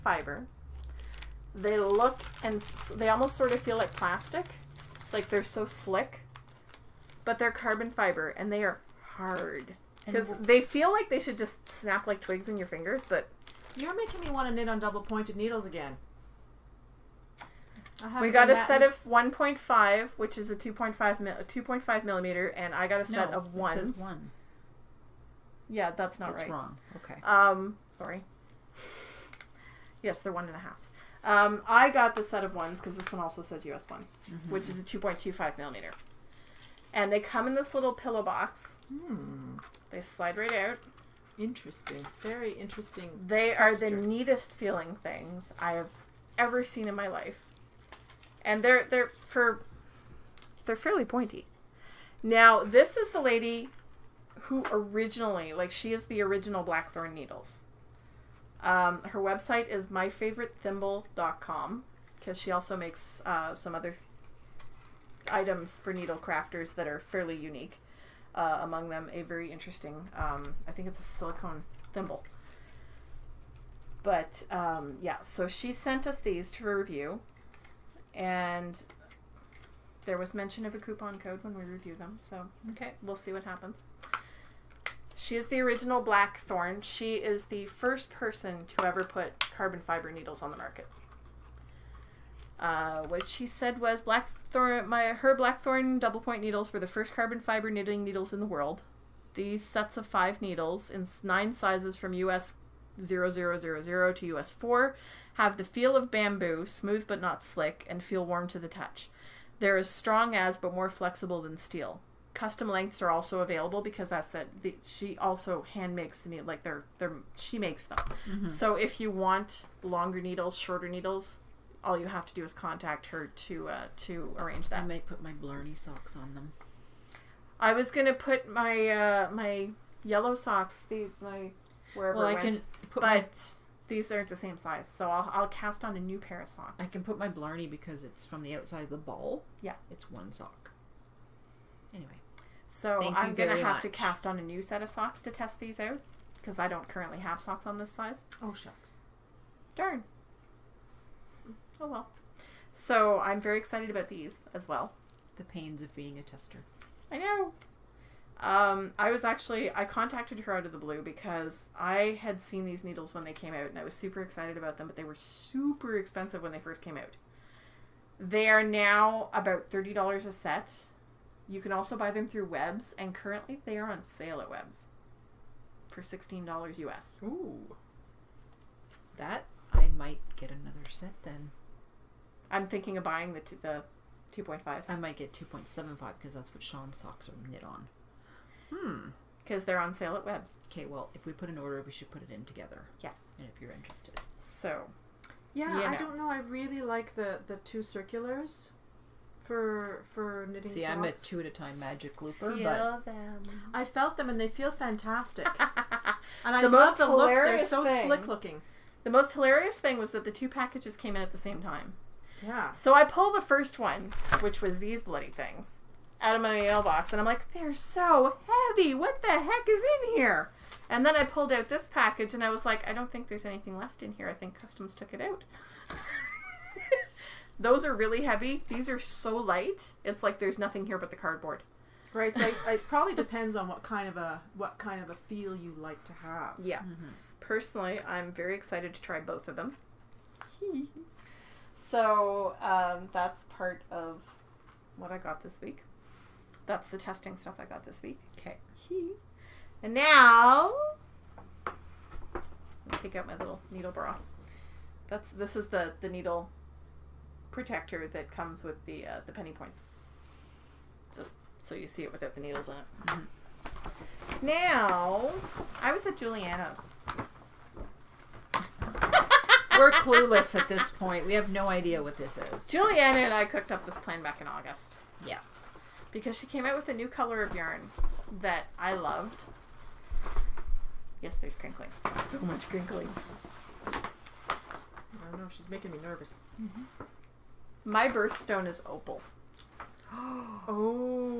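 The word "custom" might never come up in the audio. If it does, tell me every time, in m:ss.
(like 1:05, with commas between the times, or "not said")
1:52, 3:44.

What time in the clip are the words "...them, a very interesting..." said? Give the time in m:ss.
1:08.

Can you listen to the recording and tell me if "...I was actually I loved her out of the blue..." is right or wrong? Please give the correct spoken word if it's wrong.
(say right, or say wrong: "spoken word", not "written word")
wrong: "contacted", not "loved".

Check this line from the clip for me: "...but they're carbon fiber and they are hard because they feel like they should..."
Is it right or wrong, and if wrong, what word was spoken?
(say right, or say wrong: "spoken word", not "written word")
right.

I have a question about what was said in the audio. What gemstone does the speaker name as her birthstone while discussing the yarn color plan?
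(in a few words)
opal.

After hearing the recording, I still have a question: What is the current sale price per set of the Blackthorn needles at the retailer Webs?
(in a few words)
$16.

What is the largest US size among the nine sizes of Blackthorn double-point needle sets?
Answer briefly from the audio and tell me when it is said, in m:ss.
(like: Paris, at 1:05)
US 4, at 1:44.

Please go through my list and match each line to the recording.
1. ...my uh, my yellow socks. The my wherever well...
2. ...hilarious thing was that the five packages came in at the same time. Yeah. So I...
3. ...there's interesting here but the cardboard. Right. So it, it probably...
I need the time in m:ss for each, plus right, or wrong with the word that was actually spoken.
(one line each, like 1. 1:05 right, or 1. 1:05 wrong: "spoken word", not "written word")
1. 2:08 right
2. 3:29 wrong: "two", not "five"
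3. 3:50 wrong: "nothing", not "interesting".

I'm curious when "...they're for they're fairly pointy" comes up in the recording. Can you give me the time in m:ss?
0:48.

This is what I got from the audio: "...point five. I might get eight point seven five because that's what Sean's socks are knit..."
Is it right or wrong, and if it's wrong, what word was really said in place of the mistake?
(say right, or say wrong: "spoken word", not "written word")
wrong: "two", not "eight".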